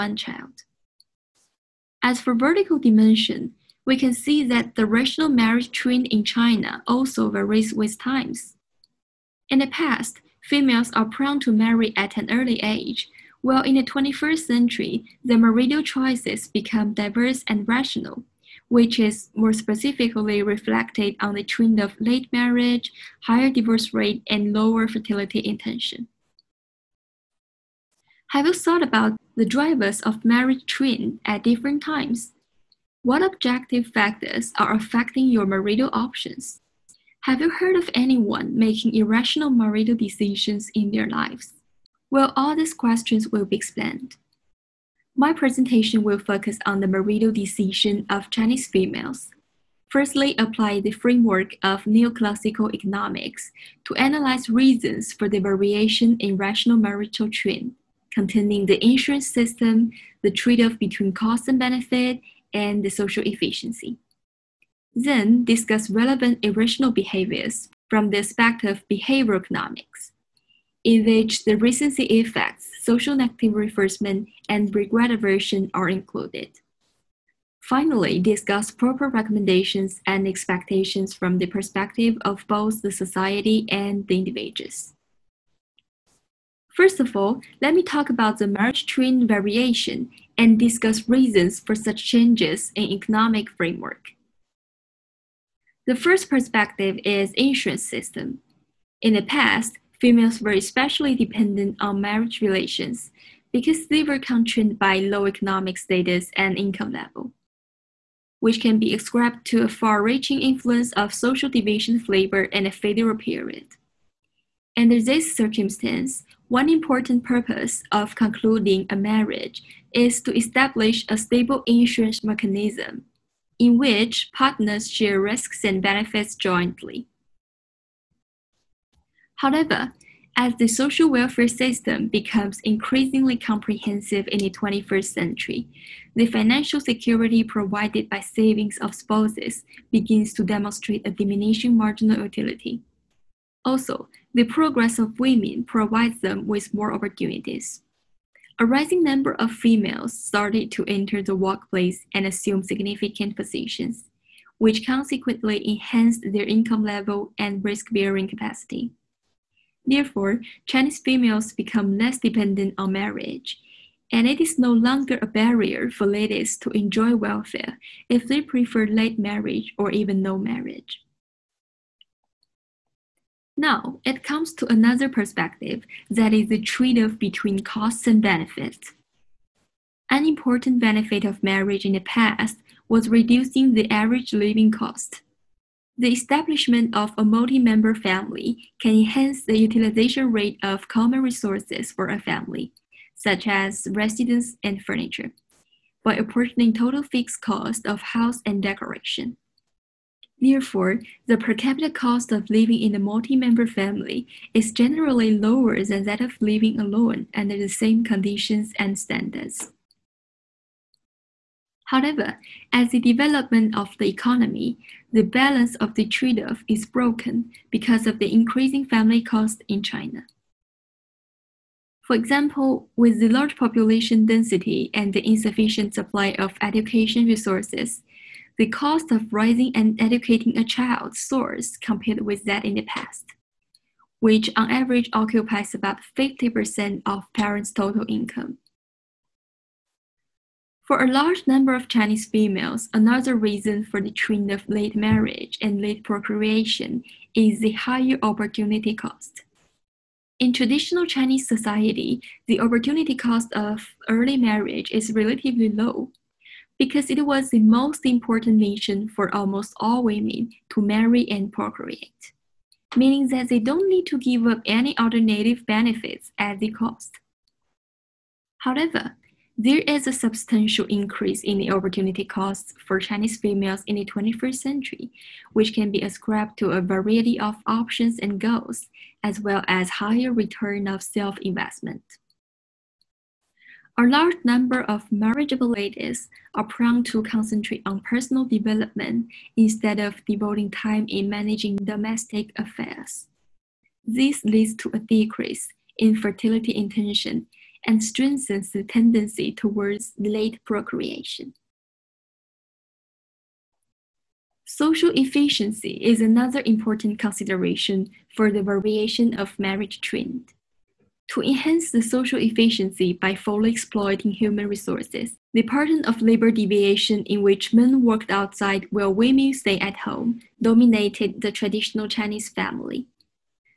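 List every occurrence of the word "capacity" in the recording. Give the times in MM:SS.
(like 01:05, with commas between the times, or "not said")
02:38.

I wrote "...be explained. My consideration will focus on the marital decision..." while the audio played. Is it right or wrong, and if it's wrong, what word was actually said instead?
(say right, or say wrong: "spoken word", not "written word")
wrong: "presentation", not "consideration".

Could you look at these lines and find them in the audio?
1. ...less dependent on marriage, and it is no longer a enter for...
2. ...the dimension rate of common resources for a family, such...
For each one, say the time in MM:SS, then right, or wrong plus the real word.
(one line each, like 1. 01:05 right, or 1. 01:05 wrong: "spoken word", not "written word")
1. 02:41 wrong: "barrier", not "enter"
2. 03:09 wrong: "utilization", not "dimension".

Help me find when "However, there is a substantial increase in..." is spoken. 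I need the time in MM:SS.
04:28.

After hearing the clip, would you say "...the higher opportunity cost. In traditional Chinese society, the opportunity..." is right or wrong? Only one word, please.
right.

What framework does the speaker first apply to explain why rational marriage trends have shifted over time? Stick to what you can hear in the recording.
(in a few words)
neoclassical economics.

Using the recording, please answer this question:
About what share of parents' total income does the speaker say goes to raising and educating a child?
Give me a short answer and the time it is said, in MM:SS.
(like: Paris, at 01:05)
50%, at 03:55.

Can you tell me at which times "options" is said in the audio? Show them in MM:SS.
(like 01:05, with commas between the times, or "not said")
00:35, 04:37.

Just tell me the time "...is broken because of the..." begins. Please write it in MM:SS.
03:36.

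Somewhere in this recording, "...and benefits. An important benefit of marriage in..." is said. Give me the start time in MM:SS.
02:58.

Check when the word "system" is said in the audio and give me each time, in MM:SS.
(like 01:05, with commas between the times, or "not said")
00:59, 01:37, 02:11.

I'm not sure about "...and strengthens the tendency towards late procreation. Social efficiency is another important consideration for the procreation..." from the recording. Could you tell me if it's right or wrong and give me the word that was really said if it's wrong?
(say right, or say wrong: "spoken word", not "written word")
wrong: "variation", not "procreation".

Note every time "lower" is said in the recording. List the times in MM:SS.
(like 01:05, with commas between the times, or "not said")
00:24, 03:25.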